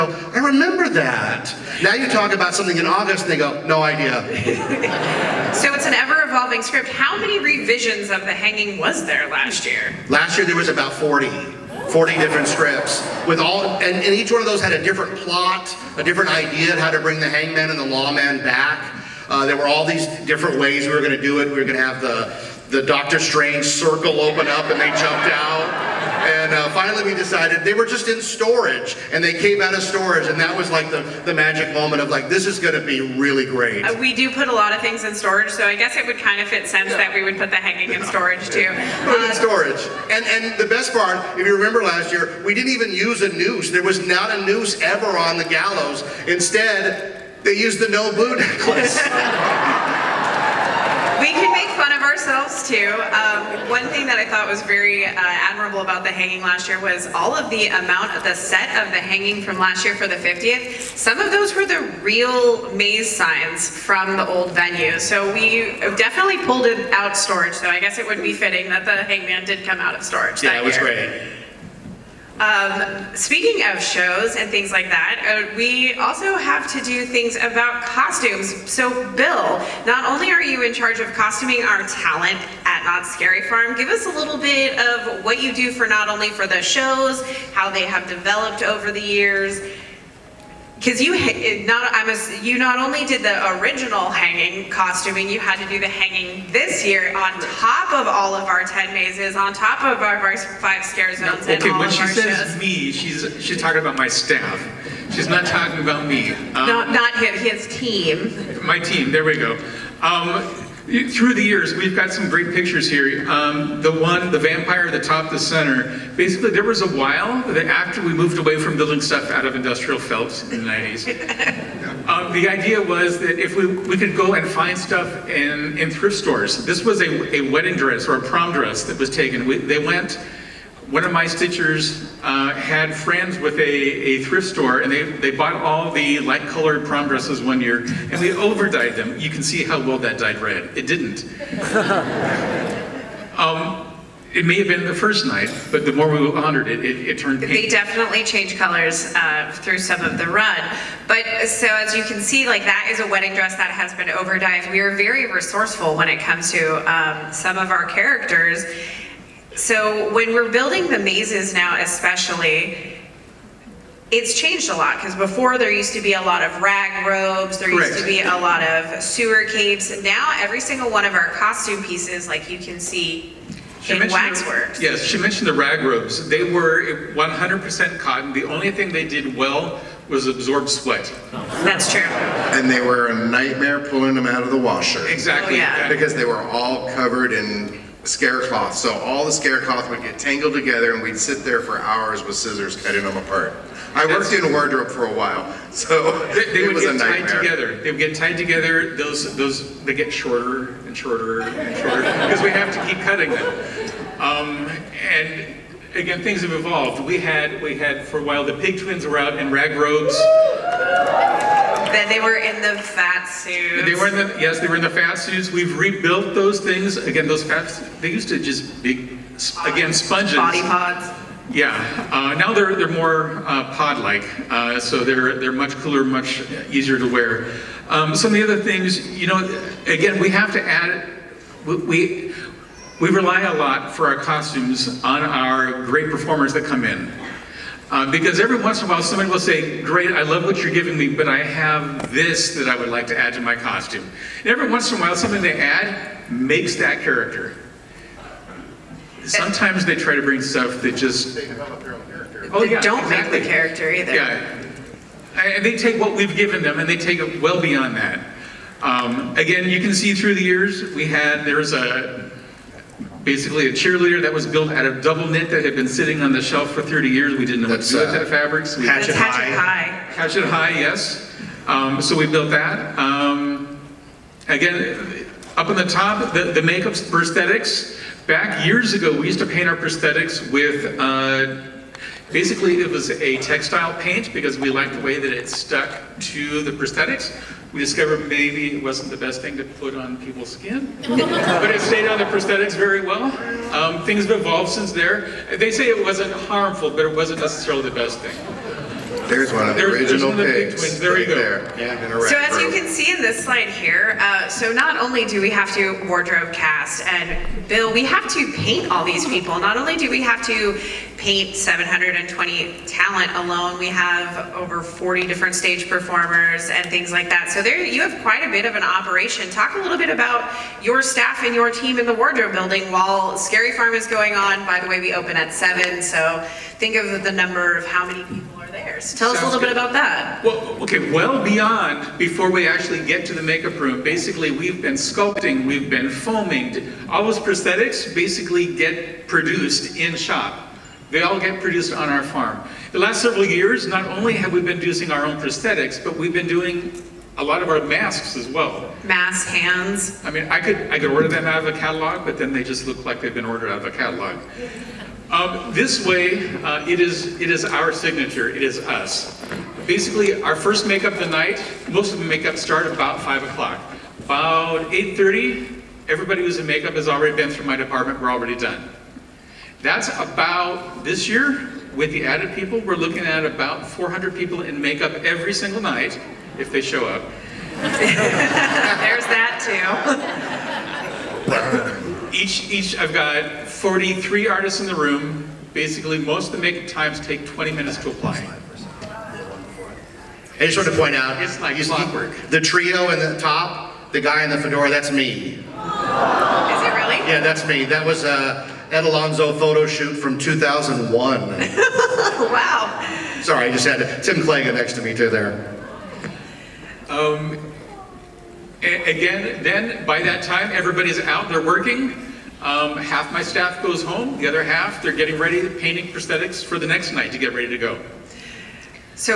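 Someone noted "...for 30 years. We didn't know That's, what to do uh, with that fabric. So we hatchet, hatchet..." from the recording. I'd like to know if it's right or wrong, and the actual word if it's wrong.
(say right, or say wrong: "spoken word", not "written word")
right.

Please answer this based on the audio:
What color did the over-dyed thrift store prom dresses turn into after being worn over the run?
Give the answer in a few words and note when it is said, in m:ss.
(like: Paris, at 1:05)
Pink, at 2:27.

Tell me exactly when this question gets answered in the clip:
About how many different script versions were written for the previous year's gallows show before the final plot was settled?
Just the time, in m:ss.
0:10.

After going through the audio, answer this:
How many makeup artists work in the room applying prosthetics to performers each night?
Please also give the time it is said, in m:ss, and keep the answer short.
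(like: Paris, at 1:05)
43, at 6:23.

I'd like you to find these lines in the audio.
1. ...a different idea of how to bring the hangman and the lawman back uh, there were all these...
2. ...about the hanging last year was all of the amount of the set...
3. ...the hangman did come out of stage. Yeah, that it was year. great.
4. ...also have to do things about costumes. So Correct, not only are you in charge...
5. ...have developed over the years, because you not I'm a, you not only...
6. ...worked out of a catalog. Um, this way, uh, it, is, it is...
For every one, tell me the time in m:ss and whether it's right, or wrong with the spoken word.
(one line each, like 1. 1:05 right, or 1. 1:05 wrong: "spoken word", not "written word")
1. 0:15 right
2. 0:55 right
3. 1:08 wrong: "storage", not "stage"
4. 1:15 wrong: "Bill", not "Correct"
5. 1:27 right
6. 5:53 wrong: "ordered", not "worked".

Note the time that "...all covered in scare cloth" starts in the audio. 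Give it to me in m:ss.
3:06.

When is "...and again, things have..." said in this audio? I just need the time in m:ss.
3:25.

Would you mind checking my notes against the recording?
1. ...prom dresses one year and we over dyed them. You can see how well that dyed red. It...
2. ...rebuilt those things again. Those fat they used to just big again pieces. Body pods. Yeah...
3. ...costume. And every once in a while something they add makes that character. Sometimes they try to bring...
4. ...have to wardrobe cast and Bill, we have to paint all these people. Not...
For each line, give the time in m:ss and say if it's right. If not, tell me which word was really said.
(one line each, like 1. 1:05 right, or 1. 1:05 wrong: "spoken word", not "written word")
1. 2:16 right
2. 3:35 wrong: "sponges", not "pieces"
3. 4:03 right
4. 5:05 right.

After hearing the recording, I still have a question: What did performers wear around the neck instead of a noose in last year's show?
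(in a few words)
No blue necklace.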